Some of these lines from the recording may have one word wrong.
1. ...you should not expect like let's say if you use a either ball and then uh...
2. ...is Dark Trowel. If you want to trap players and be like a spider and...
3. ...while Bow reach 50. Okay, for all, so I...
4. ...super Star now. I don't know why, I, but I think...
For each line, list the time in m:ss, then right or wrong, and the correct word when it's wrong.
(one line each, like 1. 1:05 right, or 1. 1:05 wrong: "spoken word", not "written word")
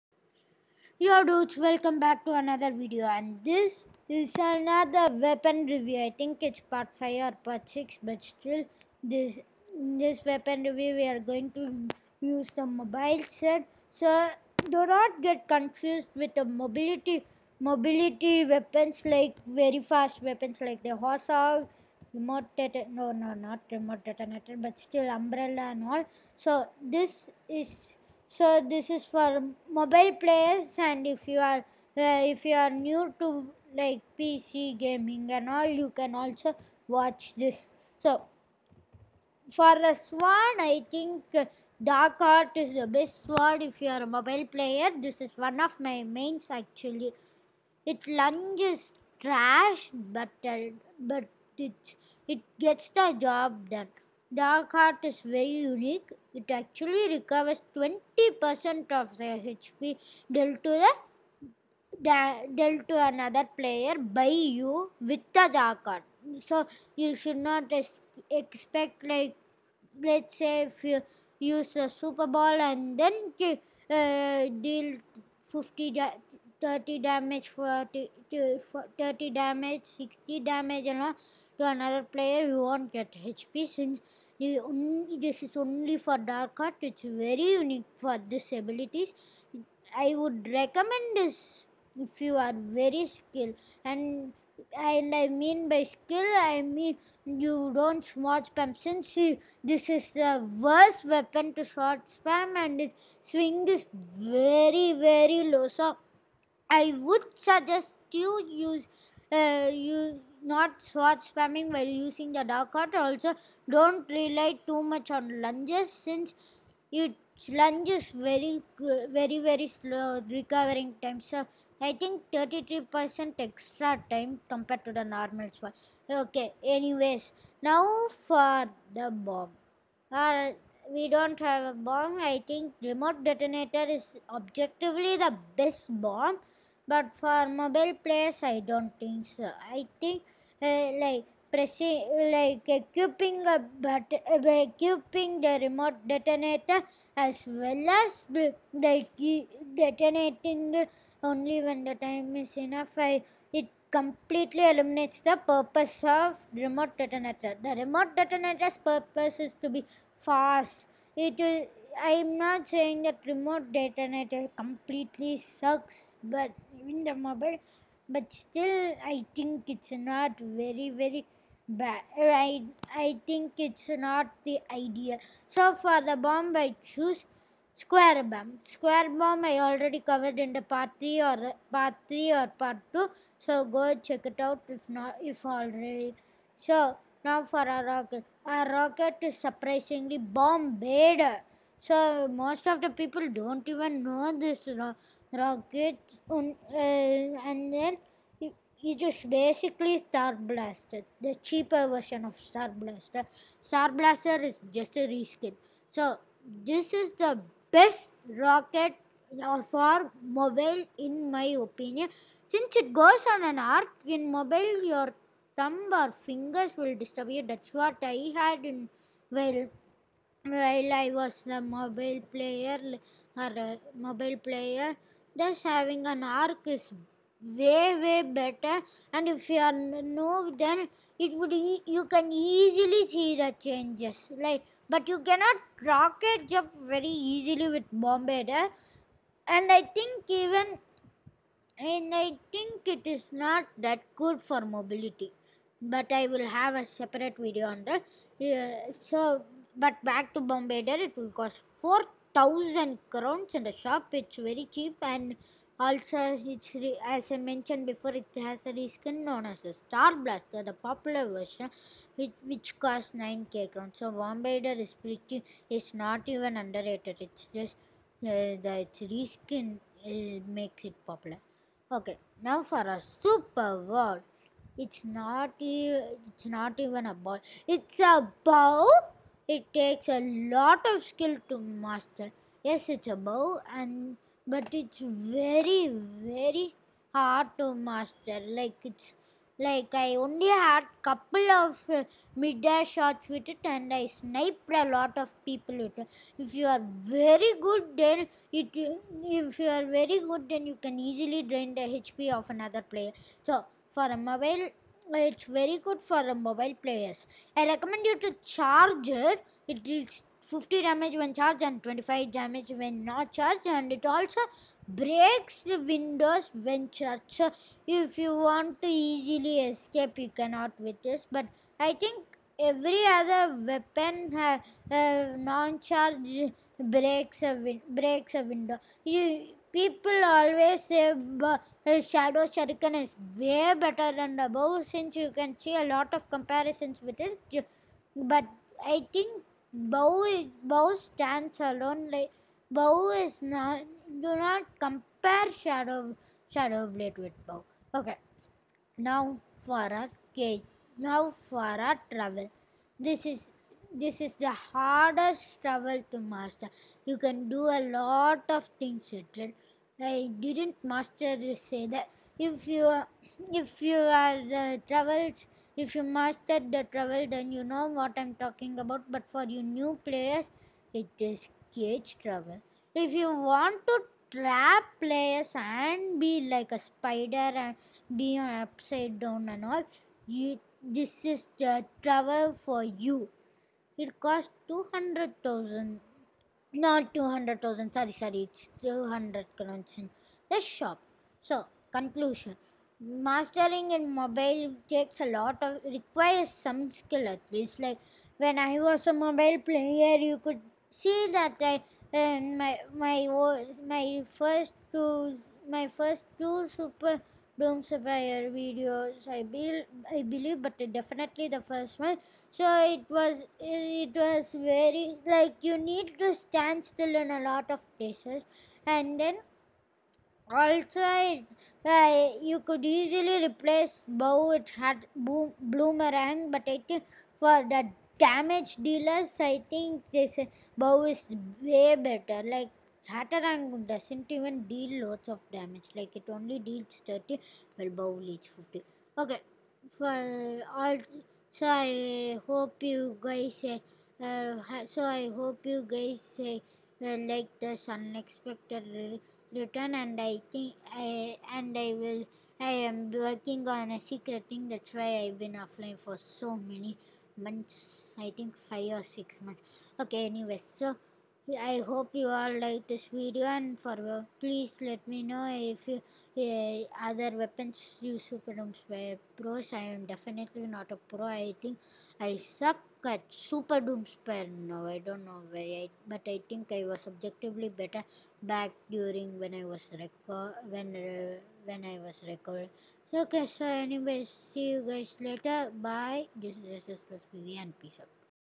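1. 1:06 wrong: "super", not "either"
2. 6:11 wrong: "Cage", not "Dark"
3. 7:17 right
4. 7:53 wrong: "Doomspire", not "Star".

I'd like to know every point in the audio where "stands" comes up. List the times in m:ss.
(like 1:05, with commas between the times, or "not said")
5:41, 6:56.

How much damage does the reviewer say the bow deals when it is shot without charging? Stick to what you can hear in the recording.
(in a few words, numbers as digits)
25.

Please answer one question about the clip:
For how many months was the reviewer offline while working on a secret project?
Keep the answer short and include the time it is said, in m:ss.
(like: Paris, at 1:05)
5 or 6 months, at 7:38.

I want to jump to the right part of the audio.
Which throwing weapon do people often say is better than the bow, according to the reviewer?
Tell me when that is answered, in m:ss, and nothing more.
5:32.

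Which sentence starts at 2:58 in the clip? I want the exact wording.
Square bomb I already covered in the part three or part three or part two.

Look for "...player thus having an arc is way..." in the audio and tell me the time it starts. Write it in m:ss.
3:44.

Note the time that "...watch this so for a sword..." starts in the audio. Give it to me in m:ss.
0:36.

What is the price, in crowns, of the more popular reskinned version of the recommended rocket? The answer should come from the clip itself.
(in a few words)
9,000 crowns.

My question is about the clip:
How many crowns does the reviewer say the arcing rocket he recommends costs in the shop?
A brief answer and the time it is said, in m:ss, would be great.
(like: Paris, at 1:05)
4,000 crowns, at 4:11.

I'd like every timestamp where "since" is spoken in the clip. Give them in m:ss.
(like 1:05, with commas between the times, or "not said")
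1:23, 1:38, 1:55, 3:32, 5:34.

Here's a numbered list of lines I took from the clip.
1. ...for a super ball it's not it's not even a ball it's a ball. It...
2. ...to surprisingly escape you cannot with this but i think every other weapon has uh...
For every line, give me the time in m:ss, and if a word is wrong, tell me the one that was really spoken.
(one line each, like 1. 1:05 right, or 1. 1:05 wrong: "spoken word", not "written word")
1. 4:32 right
2. 5:18 wrong: "easily", not "surprisingly".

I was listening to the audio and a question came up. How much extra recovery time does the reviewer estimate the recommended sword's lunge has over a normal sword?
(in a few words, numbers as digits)
33%.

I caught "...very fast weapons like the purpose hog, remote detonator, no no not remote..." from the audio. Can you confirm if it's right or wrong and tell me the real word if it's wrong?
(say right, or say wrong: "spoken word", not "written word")
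wrong: "horse", not "purpose".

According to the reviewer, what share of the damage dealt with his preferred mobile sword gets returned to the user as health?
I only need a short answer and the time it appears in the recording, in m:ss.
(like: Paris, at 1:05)
20%, at 0:57.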